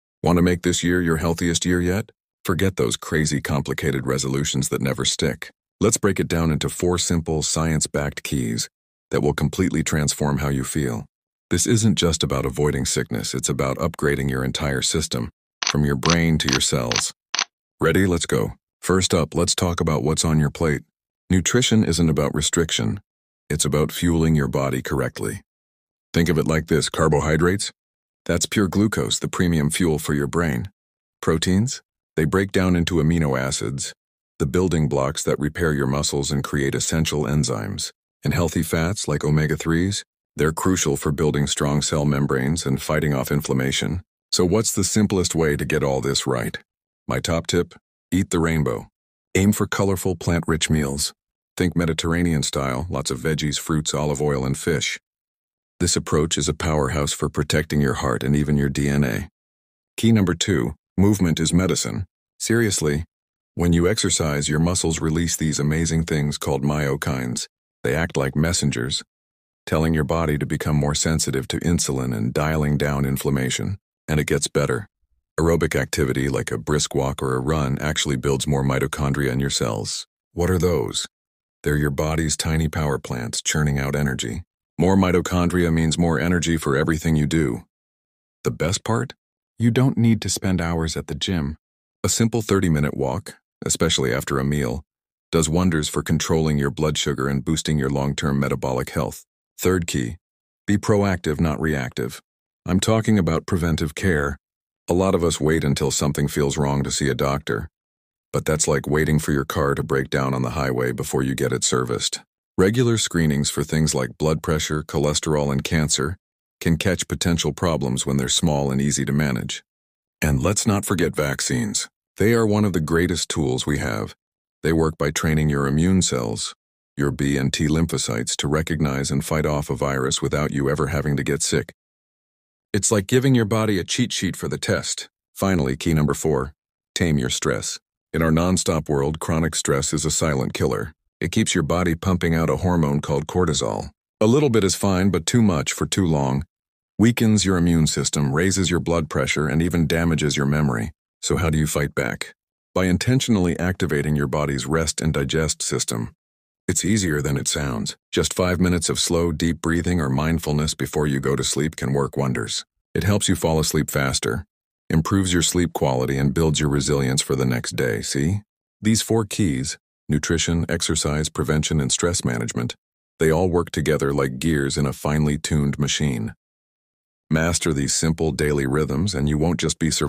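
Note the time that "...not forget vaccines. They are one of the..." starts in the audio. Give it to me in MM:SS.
02:00.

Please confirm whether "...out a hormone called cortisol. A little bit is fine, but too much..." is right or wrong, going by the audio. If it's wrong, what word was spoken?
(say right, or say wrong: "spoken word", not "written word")
right.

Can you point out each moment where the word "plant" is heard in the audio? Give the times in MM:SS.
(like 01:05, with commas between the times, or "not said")
00:50, 01:22.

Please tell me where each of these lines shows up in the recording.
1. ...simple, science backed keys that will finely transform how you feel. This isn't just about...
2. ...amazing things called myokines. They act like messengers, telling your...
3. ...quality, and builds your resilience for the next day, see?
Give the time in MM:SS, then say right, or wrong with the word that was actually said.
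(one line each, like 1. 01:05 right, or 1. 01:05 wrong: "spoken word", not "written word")
1. 00:06 wrong: "completely", not "finely"
2. 01:05 right
3. 02:45 right.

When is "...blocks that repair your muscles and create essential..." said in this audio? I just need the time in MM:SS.
00:34.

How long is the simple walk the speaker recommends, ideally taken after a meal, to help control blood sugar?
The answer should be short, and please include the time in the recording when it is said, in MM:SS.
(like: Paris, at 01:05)
30 minutes, at 01:32.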